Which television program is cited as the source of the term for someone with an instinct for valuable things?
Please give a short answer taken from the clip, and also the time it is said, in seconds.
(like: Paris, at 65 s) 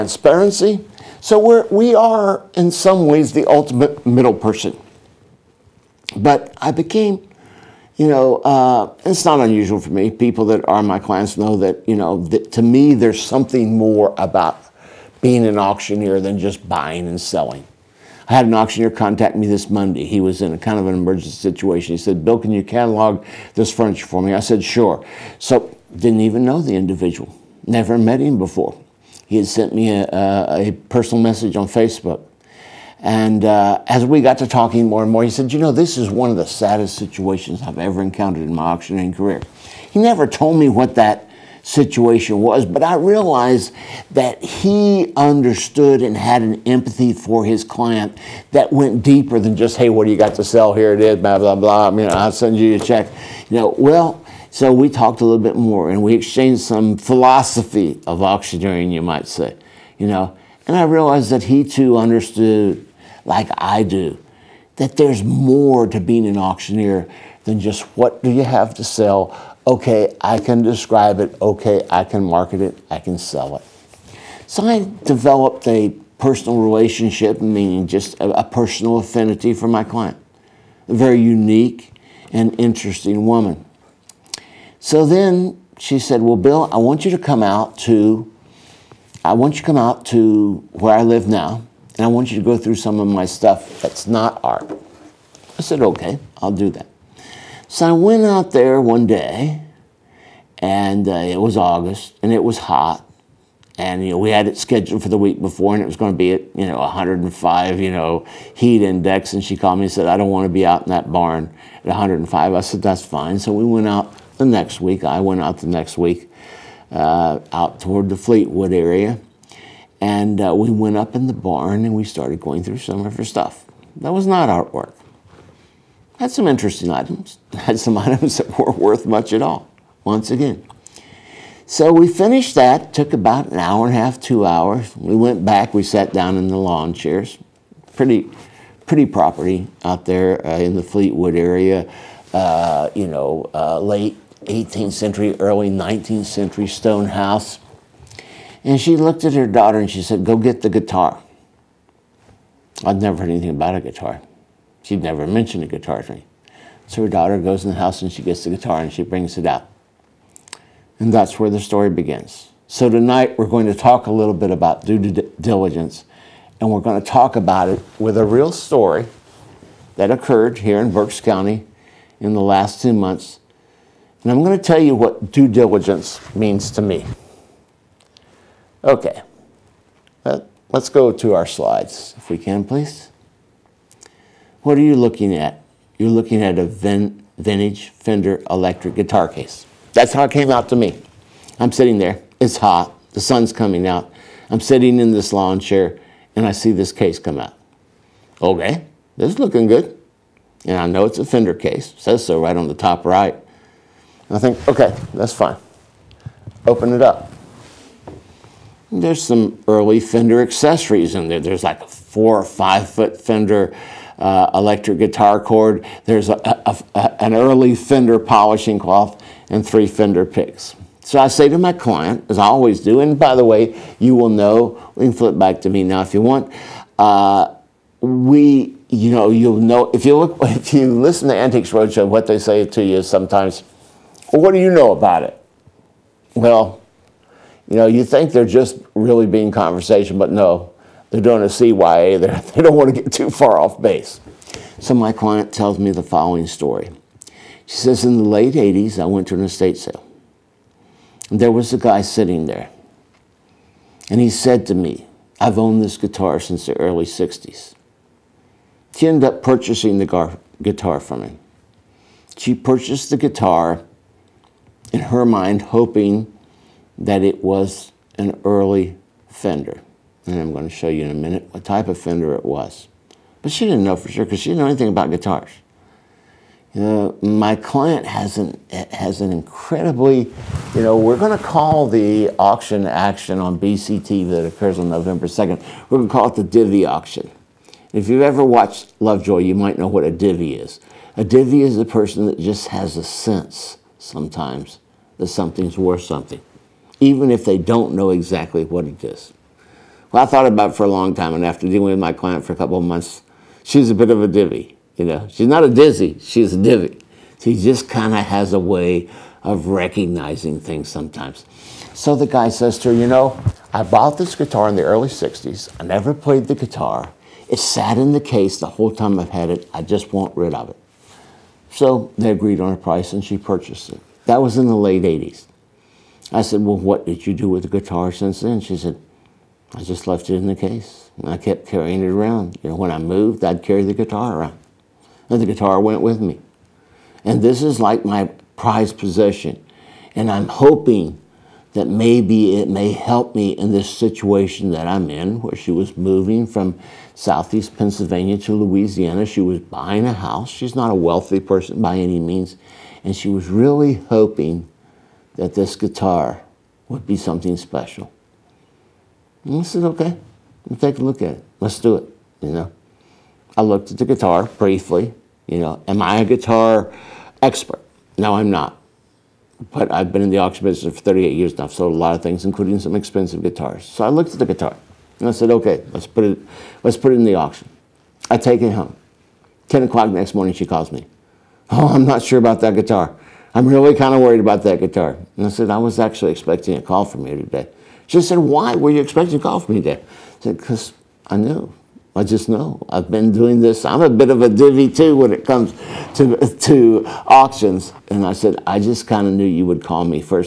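Lovejoy, at 289 s.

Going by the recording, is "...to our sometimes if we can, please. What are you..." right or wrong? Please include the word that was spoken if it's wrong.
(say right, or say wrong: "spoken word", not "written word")
wrong: "slides", not "sometimes".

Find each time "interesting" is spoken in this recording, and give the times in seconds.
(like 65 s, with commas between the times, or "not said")
82 s, 126 s.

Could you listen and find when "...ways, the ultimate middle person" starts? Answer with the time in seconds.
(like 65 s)
3 s.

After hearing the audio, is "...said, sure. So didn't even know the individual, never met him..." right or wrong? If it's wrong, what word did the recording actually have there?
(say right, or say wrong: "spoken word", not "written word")
right.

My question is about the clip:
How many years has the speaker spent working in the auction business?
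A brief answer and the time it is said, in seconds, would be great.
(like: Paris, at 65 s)
38, at 371 s.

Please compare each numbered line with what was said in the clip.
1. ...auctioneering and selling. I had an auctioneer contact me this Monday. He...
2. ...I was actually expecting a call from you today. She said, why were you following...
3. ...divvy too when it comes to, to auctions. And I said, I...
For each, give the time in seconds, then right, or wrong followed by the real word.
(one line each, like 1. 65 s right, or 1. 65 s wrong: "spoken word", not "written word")
1. 16 s wrong: "buying", not "auctioneering"
2. 385 s wrong: "expecting", not "following"
3. 394 s right.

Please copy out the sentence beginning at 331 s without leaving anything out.
And I kept carrying it around.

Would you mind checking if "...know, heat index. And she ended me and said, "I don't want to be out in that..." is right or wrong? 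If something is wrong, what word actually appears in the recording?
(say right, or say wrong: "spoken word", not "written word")
wrong: "called", not "ended".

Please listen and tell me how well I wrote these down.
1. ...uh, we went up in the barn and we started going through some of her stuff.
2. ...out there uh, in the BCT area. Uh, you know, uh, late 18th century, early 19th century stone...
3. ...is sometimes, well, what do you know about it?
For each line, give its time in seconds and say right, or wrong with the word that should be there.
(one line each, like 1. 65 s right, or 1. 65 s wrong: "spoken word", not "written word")
1. 120 s right
2. 139 s wrong: "Fleetwood", not "BCT"
3. 232 s right.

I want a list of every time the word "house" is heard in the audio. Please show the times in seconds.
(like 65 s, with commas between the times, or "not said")
147 s, 157 s, 350 s.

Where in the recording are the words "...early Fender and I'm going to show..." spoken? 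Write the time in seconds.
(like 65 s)
268 s.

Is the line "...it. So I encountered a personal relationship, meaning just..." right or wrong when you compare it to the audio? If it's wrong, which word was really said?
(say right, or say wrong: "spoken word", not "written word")
wrong: "developed", not "encountered".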